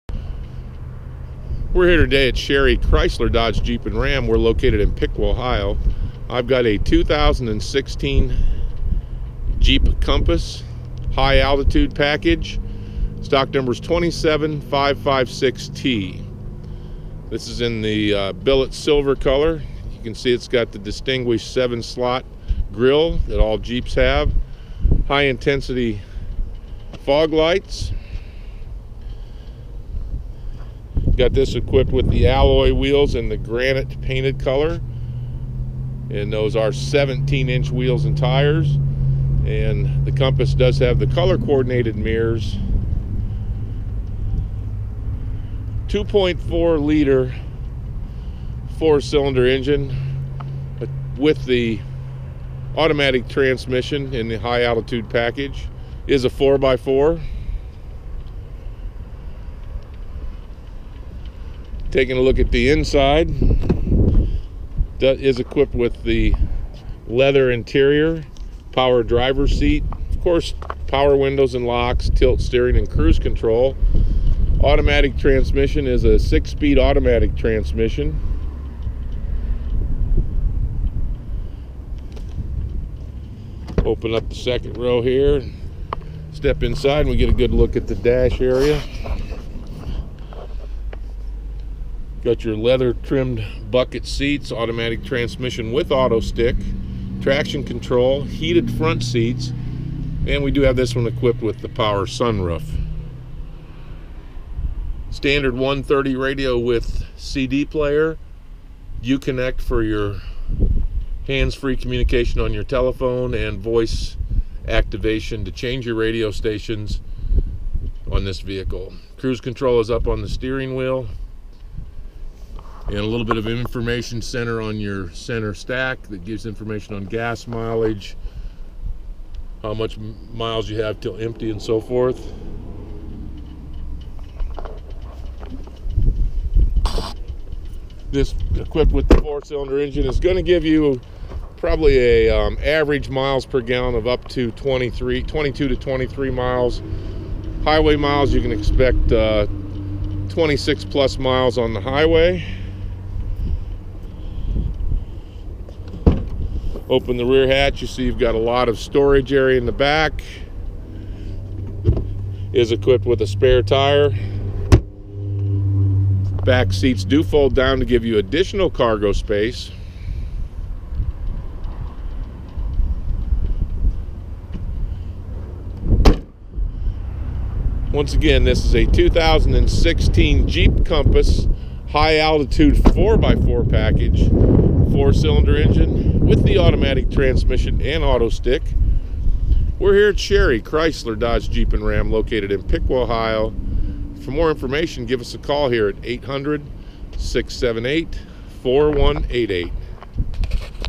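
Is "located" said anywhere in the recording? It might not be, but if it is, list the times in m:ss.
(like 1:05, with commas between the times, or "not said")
0:04, 3:12.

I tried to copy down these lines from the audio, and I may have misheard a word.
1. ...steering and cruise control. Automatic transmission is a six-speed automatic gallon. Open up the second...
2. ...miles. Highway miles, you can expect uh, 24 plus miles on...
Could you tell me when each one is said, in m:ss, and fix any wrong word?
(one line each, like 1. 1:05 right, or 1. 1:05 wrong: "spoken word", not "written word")
1. 1:12 wrong: "transmission", not "gallon"
2. 2:26 wrong: "26", not "24".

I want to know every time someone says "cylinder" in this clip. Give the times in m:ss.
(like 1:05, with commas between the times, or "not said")
0:49, 2:19, 3:05.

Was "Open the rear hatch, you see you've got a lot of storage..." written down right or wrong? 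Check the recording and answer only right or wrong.
right.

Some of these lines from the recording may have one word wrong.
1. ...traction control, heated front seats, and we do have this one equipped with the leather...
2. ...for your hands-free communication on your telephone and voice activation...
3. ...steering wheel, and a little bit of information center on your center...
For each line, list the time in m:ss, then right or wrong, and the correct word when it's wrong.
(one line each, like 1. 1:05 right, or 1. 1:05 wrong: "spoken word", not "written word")
1. 1:37 wrong: "power", not "leather"
2. 1:49 right
3. 2:00 right.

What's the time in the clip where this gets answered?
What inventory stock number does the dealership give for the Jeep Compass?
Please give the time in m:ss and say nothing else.
0:13.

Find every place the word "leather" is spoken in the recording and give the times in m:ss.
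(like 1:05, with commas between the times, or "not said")
1:07, 1:32.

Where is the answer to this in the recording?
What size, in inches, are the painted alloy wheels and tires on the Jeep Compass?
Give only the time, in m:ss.
0:36.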